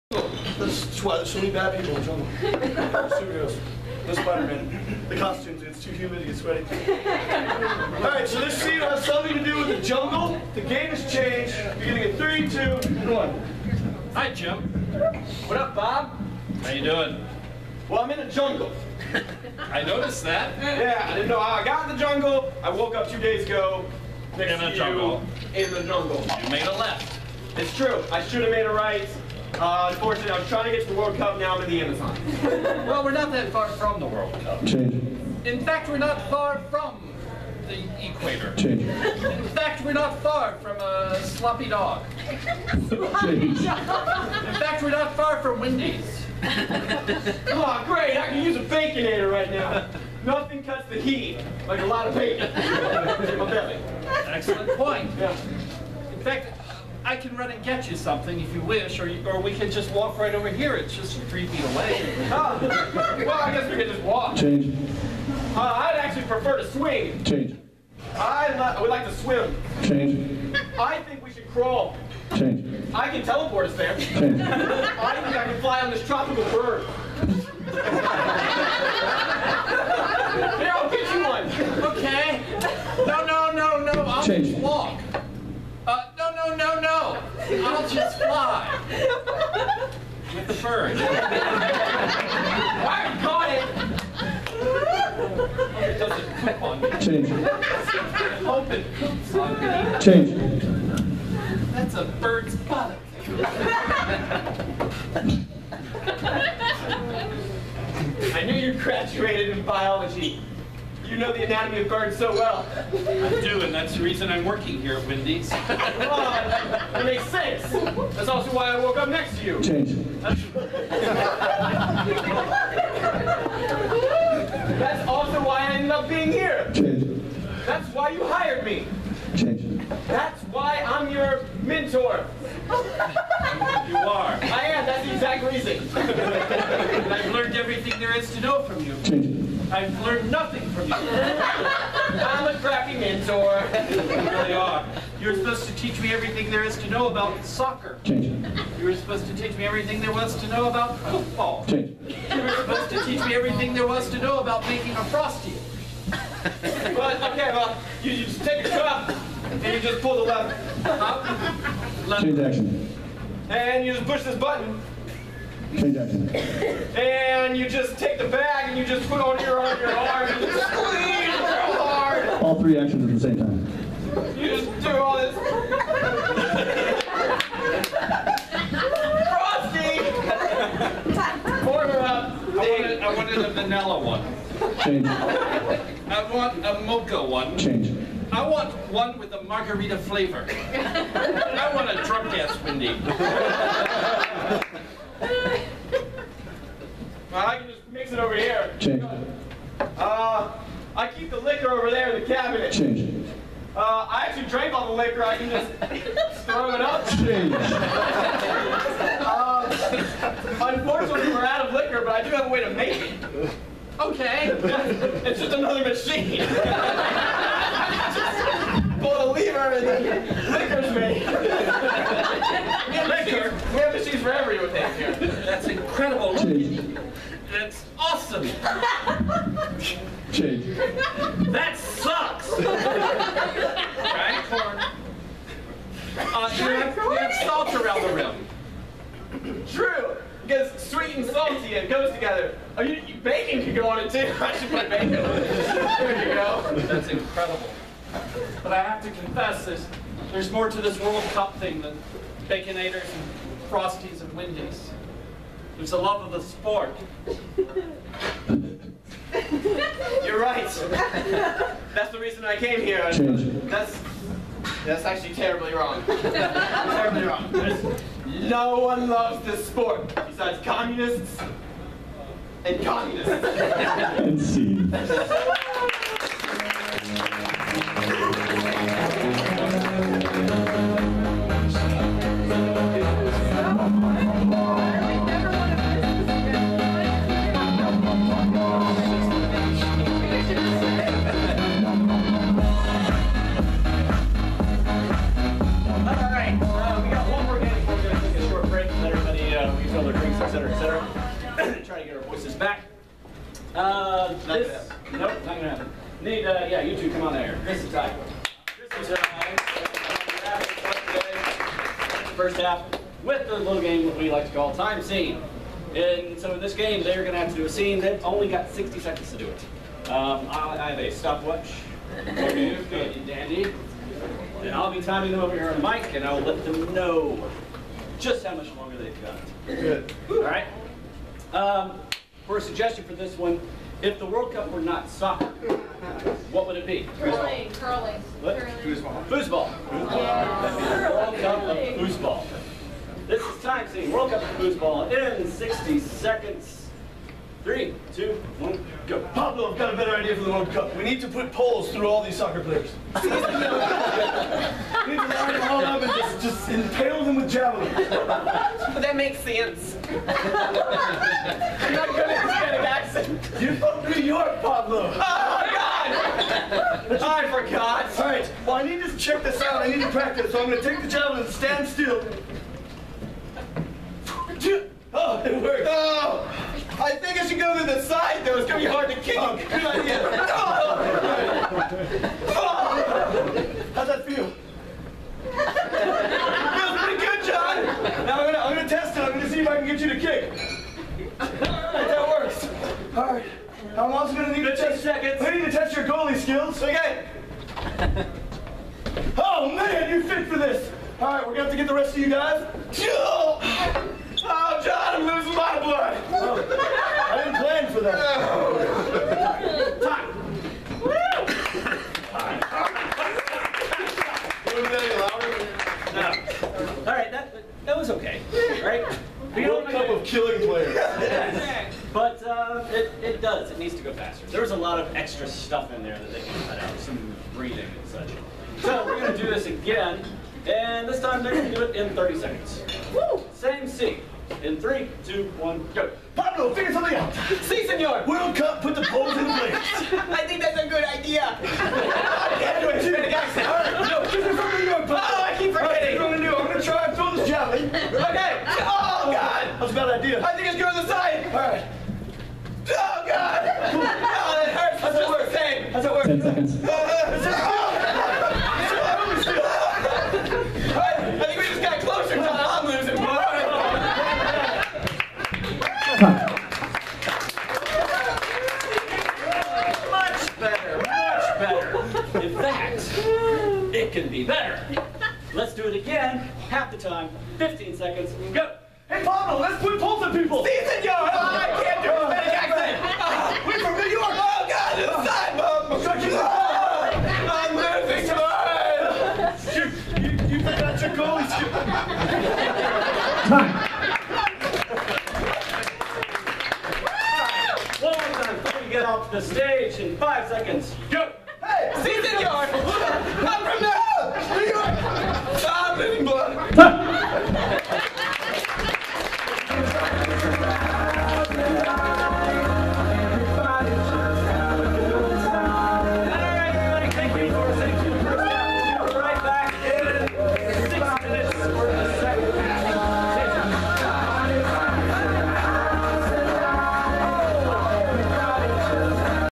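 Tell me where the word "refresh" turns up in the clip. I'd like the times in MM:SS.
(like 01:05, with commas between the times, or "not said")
not said.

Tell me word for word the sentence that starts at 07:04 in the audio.
There was a lot of extra stuff in there that they can cut out, some breathing and such.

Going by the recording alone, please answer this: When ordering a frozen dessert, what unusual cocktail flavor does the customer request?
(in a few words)
margarita.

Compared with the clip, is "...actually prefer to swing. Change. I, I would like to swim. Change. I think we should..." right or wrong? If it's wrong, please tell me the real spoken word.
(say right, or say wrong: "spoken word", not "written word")
right.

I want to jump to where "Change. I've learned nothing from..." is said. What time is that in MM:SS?
02:19.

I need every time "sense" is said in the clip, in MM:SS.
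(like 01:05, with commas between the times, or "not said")
01:57, 05:59.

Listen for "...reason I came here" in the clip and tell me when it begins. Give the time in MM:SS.
04:22.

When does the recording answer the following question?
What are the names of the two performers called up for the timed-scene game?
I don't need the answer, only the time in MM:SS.
05:07.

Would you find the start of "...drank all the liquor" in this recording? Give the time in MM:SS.
03:24.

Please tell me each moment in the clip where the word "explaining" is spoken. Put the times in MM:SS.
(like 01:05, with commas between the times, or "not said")
not said.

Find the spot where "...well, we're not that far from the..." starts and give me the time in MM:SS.
00:32.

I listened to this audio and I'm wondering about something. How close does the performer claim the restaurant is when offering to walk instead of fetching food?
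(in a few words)
3 feet.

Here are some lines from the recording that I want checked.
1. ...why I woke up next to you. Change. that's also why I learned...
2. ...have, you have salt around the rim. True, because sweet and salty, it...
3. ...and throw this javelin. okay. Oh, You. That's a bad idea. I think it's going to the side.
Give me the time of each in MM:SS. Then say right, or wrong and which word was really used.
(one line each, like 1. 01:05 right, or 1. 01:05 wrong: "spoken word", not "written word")
1. 01:58 wrong: "ended", not "learned"
2. 03:56 right
3. 07:27 wrong: "God", not "You".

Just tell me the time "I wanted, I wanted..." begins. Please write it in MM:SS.
03:02.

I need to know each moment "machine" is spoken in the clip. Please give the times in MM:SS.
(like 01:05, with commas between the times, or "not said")
03:35, 03:43.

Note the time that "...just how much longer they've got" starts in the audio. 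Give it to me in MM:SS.
05:28.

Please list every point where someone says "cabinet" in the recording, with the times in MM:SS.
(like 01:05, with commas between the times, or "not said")
03:22.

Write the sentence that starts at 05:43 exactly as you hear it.
This is time seeing World Cup of foosball in 60 seconds.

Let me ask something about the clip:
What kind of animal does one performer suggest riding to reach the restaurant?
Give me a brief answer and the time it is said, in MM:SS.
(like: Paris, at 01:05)
tropical bird, at 01:16.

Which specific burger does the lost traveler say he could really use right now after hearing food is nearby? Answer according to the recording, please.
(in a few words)
Baconator.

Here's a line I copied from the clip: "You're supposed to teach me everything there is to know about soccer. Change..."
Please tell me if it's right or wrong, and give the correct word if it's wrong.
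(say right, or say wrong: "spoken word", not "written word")
right.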